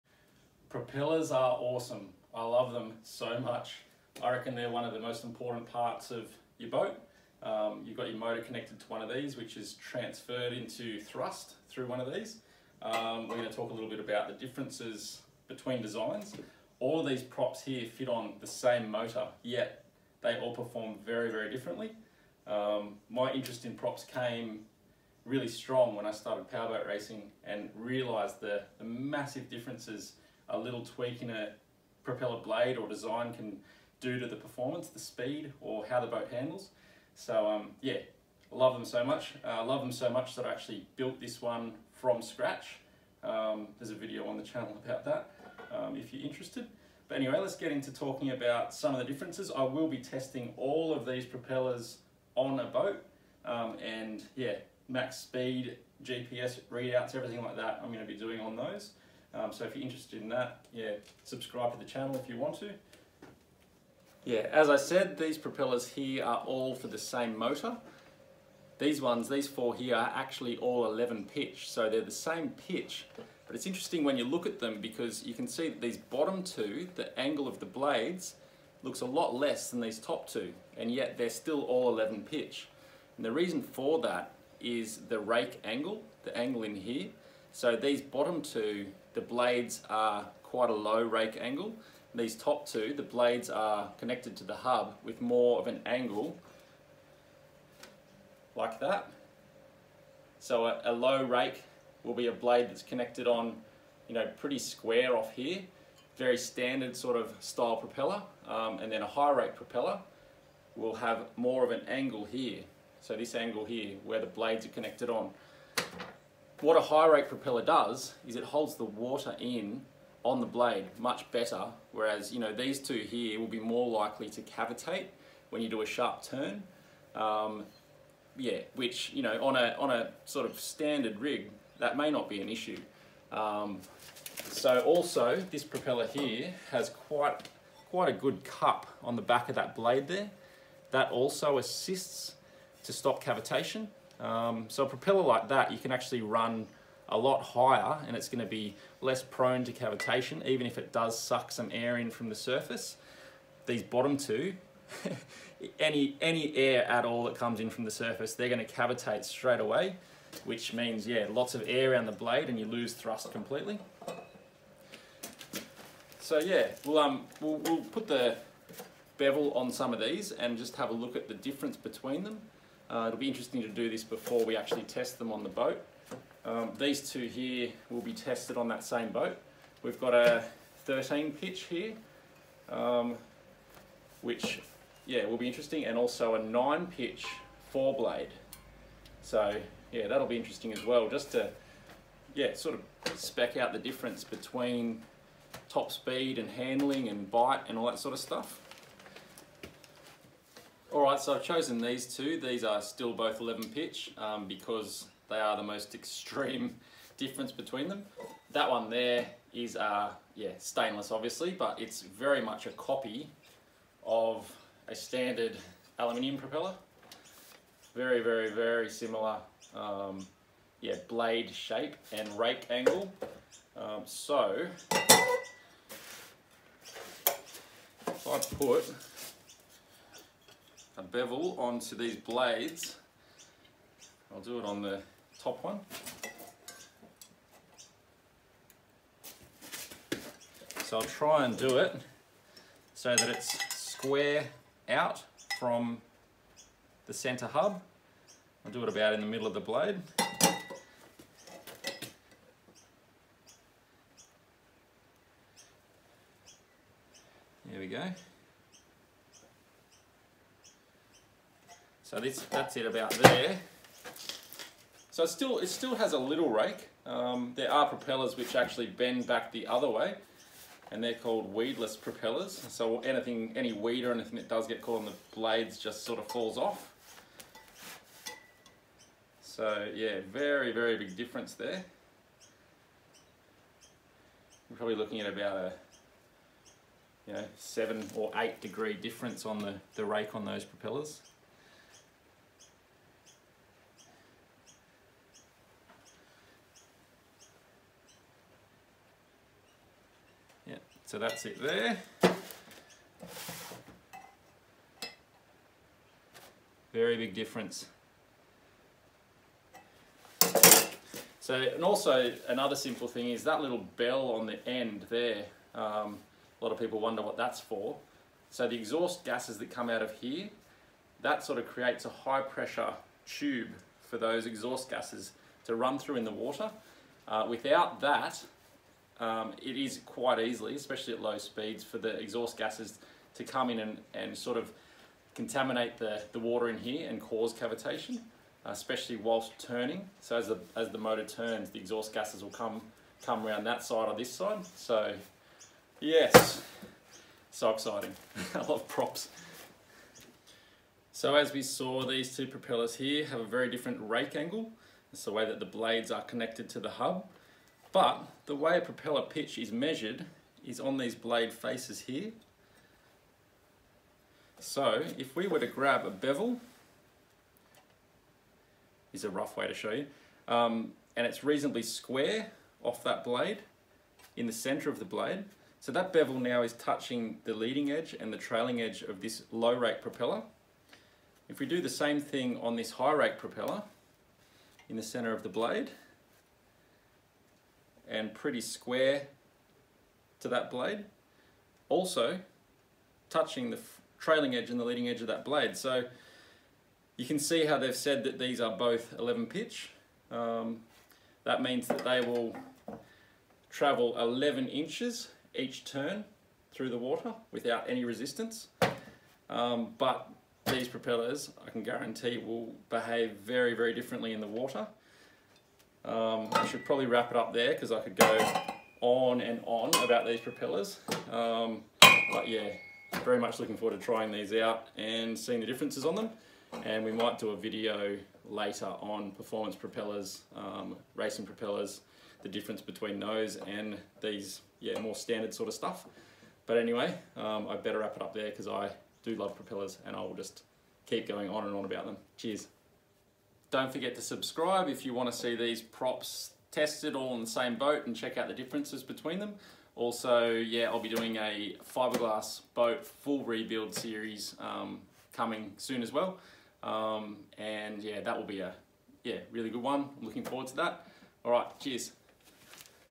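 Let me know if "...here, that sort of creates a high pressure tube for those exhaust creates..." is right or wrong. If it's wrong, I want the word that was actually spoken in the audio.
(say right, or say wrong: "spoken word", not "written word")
wrong: "gases", not "creates".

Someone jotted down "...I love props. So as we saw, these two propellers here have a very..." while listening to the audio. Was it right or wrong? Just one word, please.
right.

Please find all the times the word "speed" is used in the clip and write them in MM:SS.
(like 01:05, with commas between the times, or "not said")
00:34, 00:55, 03:15, 05:31.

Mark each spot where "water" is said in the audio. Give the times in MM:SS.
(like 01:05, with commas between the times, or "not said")
01:58, 05:26, 05:36, 06:46, 06:54.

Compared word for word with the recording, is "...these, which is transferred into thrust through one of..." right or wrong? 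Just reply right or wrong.
right.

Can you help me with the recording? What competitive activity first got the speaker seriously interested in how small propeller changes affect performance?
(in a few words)
Powerboat racing.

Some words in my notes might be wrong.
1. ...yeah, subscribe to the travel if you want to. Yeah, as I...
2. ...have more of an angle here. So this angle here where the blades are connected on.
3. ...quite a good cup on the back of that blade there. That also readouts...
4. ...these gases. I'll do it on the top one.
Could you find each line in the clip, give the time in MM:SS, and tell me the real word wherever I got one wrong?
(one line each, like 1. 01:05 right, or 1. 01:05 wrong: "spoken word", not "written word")
1. 01:00 wrong: "channel", not "travel"
2. 01:50 right
3. 02:17 wrong: "assists", not "readouts"
4. 03:51 wrong: "blades", not "gases".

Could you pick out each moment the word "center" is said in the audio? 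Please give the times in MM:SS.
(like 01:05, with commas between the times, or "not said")
04:07, 06:14, 06:25.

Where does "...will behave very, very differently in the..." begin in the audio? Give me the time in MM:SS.
06:52.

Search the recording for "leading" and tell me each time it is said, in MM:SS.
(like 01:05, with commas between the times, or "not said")
06:17, 06:34.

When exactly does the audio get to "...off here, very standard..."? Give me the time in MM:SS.
01:45.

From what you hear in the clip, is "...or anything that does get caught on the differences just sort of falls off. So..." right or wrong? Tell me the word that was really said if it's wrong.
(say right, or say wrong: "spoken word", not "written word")
wrong: "blades", not "differences".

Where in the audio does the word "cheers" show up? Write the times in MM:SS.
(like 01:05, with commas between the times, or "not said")
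07:22, 07:41.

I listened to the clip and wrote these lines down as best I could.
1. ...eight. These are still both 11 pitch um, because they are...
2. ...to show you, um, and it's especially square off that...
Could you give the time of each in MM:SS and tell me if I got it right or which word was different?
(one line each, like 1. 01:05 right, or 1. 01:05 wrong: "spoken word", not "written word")
1. 03:22 wrong: "two", not "eight"
2. 06:09 wrong: "reasonably", not "especially".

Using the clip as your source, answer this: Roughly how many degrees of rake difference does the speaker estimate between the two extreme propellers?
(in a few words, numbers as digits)
7 or 8.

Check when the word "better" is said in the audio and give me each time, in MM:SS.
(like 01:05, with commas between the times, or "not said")
02:01, 07:17.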